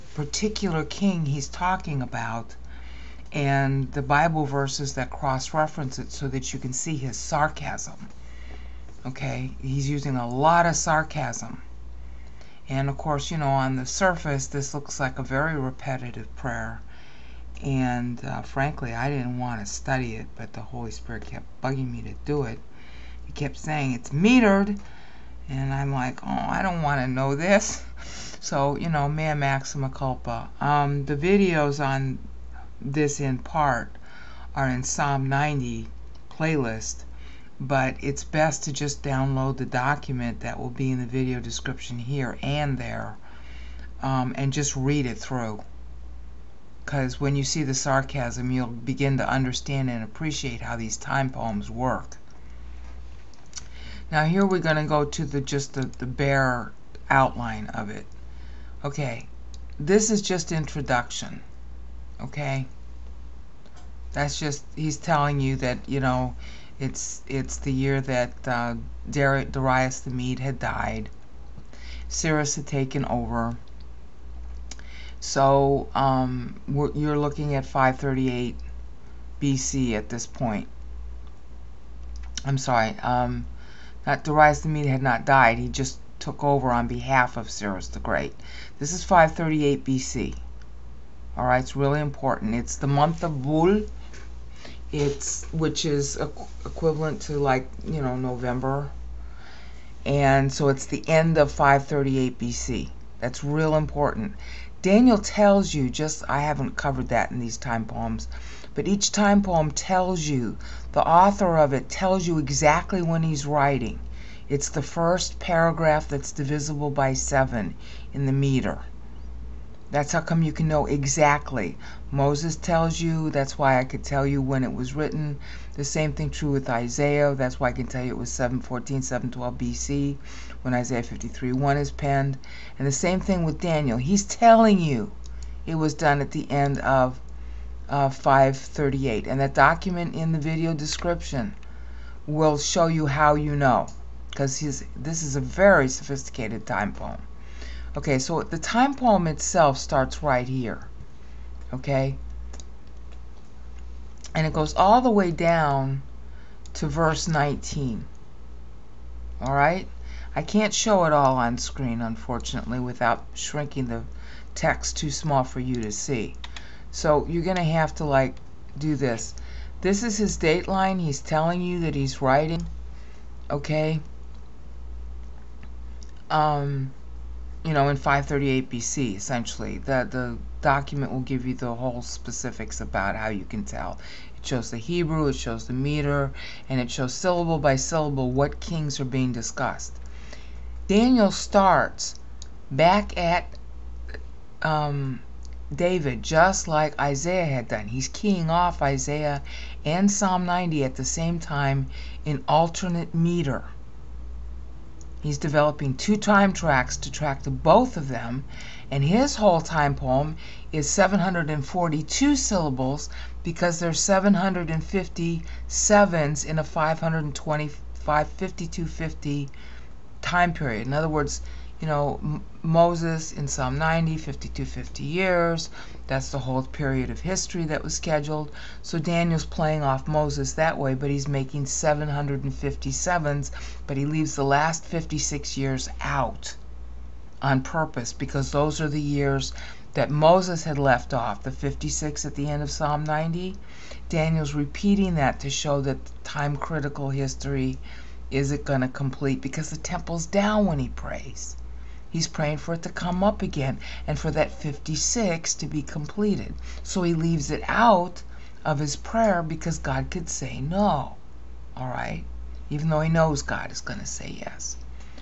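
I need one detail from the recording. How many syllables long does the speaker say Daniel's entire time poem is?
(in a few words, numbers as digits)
742.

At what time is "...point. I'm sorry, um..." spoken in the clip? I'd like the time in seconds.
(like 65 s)
80 s.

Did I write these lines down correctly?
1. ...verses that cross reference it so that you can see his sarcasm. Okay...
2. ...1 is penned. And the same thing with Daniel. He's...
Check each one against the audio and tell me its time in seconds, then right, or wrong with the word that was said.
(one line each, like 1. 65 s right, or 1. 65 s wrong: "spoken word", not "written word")
1. 4 s right
2. 131 s right.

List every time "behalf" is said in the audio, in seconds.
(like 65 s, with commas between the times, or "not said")
86 s.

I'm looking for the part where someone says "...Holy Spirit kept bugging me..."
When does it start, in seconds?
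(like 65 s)
20 s.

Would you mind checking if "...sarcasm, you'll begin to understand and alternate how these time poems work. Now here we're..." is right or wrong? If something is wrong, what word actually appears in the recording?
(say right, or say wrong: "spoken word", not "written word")
wrong: "appreciate", not "alternate".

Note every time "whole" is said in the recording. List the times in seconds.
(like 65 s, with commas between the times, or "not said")
181 s, 209 s, 226 s.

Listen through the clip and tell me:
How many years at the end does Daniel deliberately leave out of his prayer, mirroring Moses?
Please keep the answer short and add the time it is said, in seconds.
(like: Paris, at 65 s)
56, at 234 s.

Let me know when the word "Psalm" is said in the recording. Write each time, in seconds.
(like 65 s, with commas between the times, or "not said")
34 s, 200 s, 223 s, 242 s.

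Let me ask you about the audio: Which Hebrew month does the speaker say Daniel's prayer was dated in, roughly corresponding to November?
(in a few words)
Bul.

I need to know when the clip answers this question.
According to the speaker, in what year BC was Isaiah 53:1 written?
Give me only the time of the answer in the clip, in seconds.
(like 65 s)
128 s.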